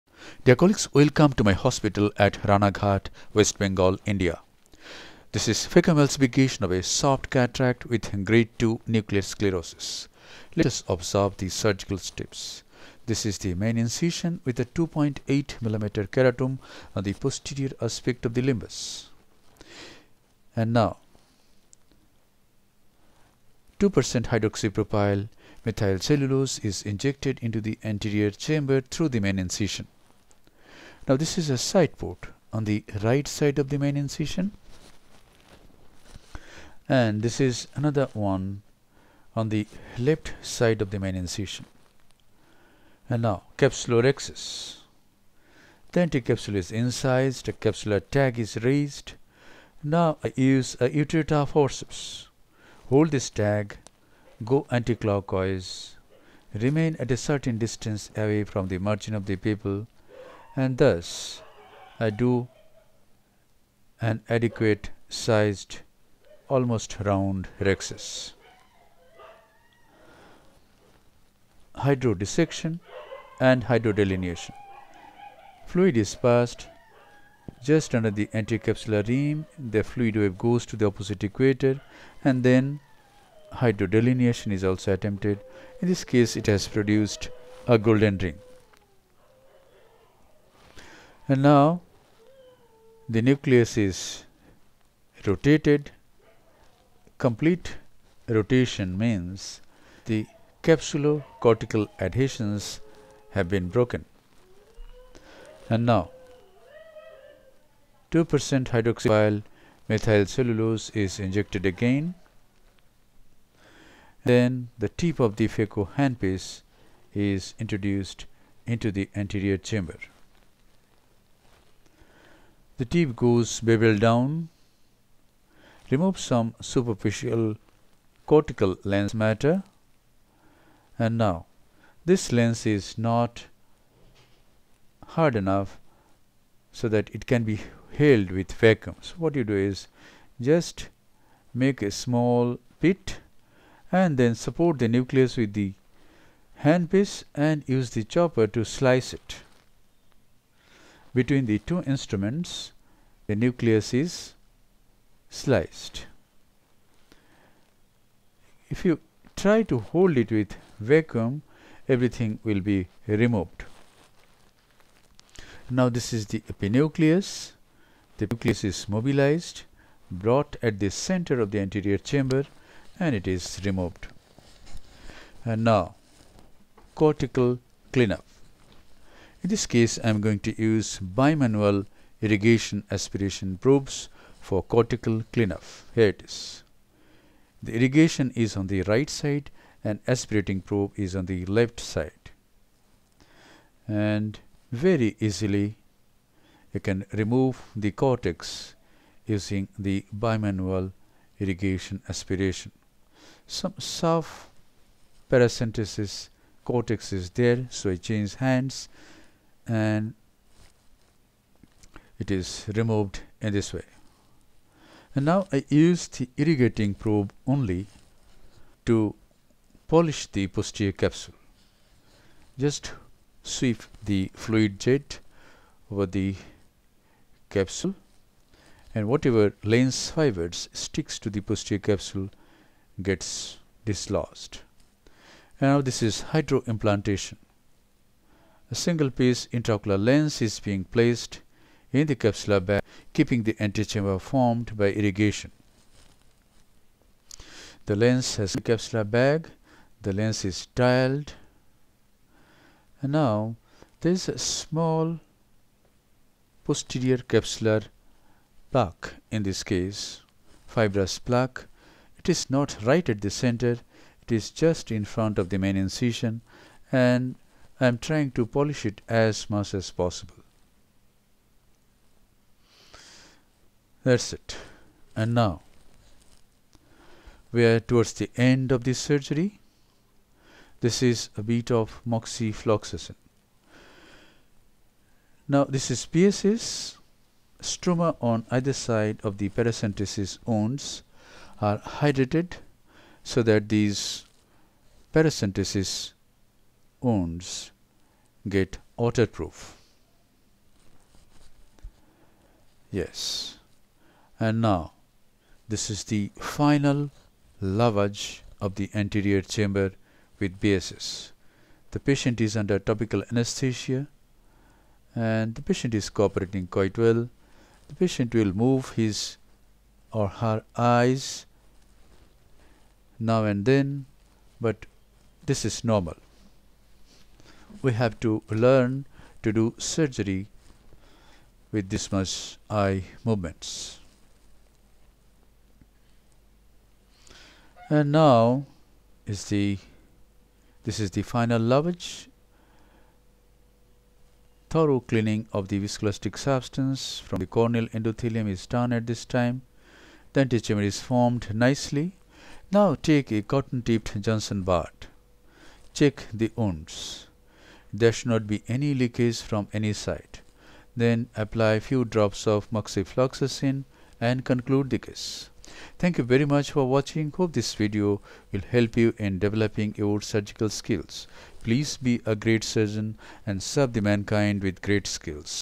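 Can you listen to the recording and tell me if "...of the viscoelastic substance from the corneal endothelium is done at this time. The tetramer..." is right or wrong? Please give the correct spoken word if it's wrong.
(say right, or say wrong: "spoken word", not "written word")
right.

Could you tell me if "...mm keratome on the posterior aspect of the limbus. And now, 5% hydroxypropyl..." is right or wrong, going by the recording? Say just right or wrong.
wrong.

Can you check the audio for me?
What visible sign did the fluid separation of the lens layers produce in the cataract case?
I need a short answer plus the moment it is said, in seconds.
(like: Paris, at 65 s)
golden ring, at 87 s.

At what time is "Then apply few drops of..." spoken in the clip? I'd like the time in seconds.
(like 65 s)
360 s.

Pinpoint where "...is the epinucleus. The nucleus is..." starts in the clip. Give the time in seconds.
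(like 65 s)
166 s.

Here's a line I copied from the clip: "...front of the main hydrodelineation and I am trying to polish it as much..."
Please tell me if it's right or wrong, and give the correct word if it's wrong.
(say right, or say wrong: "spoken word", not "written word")
wrong: "incision", not "hydrodelineation".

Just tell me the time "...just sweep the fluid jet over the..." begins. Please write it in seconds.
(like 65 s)
222 s.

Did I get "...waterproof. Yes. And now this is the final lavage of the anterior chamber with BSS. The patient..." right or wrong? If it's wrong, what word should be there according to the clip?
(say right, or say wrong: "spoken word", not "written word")
right.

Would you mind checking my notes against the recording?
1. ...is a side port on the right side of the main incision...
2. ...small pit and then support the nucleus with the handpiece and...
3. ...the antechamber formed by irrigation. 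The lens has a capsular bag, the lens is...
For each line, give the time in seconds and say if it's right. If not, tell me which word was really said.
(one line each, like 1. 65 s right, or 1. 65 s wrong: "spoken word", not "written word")
1. 31 s right
2. 141 s right
3. 243 s right.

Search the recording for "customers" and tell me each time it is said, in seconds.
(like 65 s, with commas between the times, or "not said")
not said.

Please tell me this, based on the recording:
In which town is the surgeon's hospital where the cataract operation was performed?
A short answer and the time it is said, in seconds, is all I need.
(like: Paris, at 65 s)
Ranaghat, at 2 s.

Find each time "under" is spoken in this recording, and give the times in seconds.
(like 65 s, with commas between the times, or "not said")
77 s, 312 s.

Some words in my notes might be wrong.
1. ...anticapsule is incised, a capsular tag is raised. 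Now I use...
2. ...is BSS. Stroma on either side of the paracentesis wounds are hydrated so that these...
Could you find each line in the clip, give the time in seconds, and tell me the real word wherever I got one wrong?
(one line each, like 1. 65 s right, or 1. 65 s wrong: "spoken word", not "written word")
1. 46 s right
2. 285 s right.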